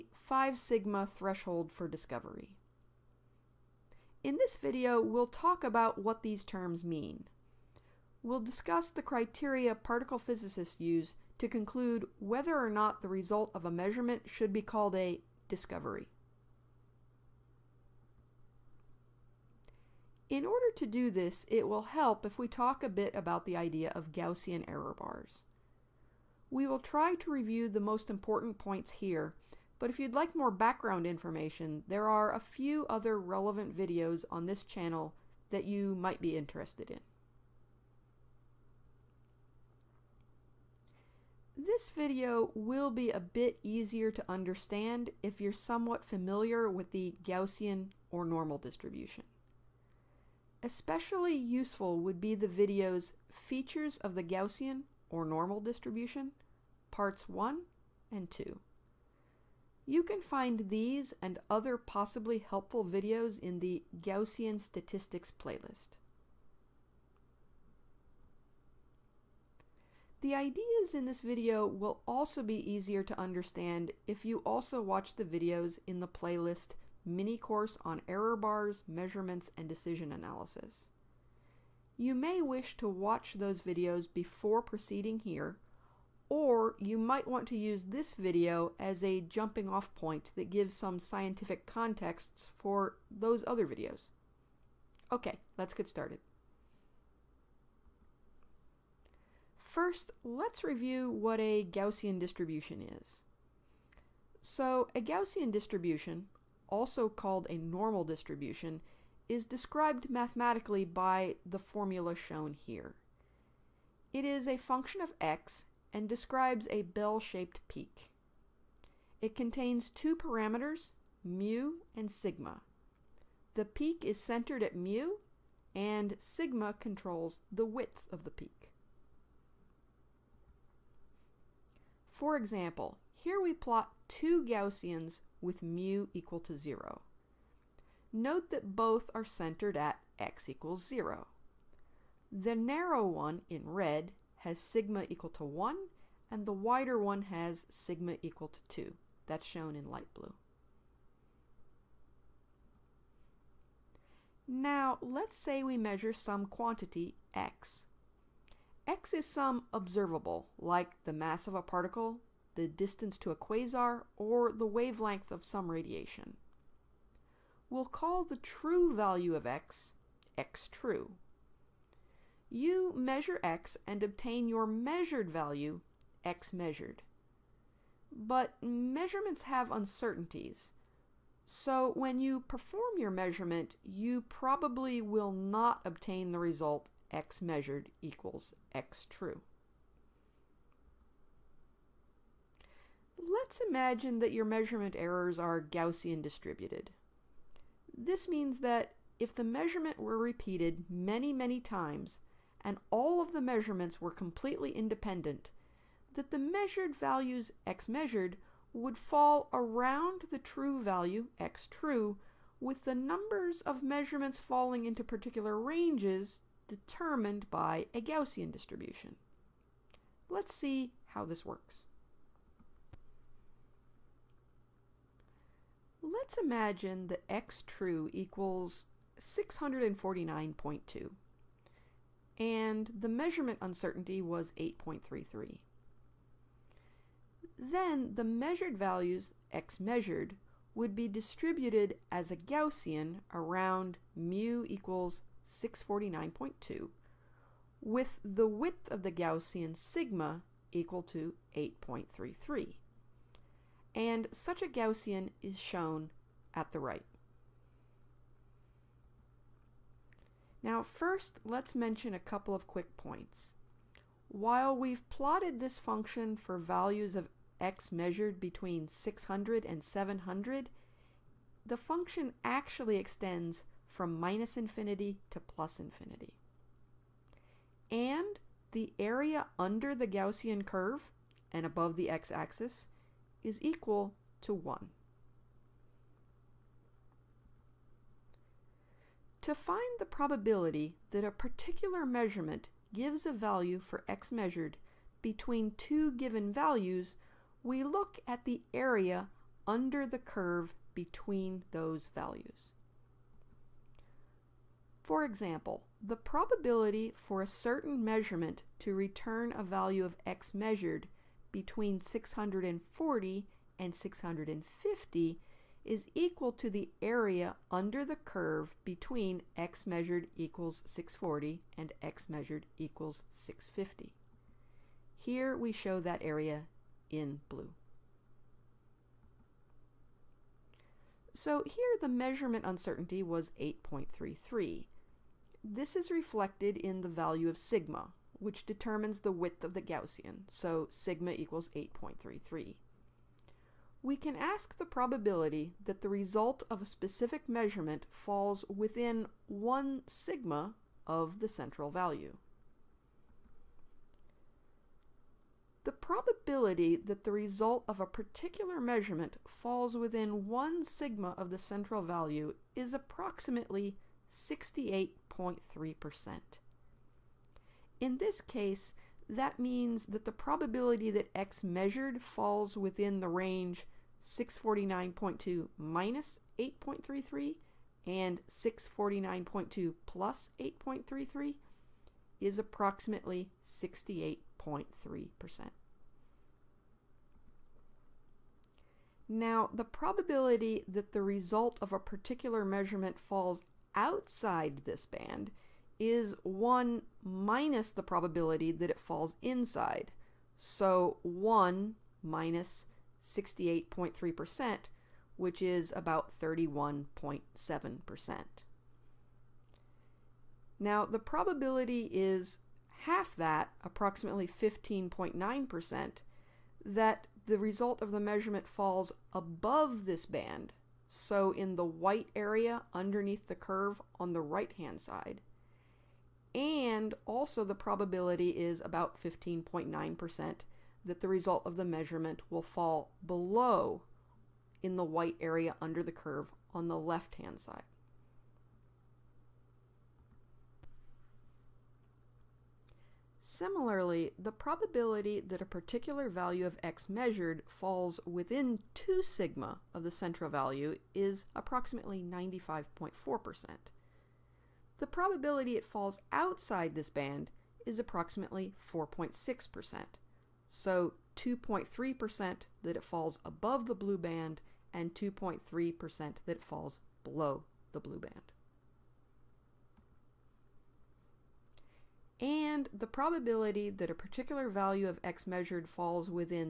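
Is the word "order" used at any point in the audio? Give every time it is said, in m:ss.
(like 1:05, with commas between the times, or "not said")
0:20.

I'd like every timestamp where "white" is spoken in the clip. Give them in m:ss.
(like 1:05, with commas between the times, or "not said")
7:01, 7:15.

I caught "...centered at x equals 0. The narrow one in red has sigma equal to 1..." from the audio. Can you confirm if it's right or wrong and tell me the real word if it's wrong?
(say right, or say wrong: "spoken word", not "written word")
right.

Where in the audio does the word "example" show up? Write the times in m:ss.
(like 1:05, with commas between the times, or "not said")
2:12, 5:05.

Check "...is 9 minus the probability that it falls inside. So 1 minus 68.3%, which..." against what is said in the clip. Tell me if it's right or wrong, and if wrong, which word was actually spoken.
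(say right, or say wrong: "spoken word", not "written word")
wrong: "1", not "9".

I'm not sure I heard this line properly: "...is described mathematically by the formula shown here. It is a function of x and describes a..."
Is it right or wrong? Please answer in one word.
right.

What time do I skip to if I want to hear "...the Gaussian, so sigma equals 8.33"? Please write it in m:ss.
5:39.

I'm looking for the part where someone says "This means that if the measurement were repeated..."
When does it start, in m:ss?
3:17.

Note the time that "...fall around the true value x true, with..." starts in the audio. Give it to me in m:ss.
3:28.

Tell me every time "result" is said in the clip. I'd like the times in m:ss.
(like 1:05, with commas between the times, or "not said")
0:13, 3:06, 5:46, 5:57, 6:31, 6:57, 7:11.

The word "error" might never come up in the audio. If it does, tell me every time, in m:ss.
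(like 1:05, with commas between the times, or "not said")
0:24, 1:18, 3:14.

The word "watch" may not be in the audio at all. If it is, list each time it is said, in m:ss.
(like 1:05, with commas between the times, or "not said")
1:14, 1:22.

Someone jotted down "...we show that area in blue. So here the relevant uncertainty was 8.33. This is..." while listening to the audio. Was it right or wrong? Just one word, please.
wrong.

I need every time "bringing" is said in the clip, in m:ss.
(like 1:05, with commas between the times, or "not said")
not said.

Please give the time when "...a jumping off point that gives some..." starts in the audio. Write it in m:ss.
1:29.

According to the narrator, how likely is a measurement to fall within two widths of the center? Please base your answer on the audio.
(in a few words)
95.4%.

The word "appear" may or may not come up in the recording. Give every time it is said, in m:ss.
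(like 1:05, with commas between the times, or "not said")
not said.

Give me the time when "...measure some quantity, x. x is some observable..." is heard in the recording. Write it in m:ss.
2:35.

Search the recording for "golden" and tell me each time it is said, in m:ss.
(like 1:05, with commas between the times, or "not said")
not said.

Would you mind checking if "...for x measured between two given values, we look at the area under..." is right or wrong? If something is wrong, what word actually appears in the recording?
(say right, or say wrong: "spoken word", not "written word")
right.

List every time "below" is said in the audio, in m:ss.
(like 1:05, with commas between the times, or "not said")
7:13, 7:47.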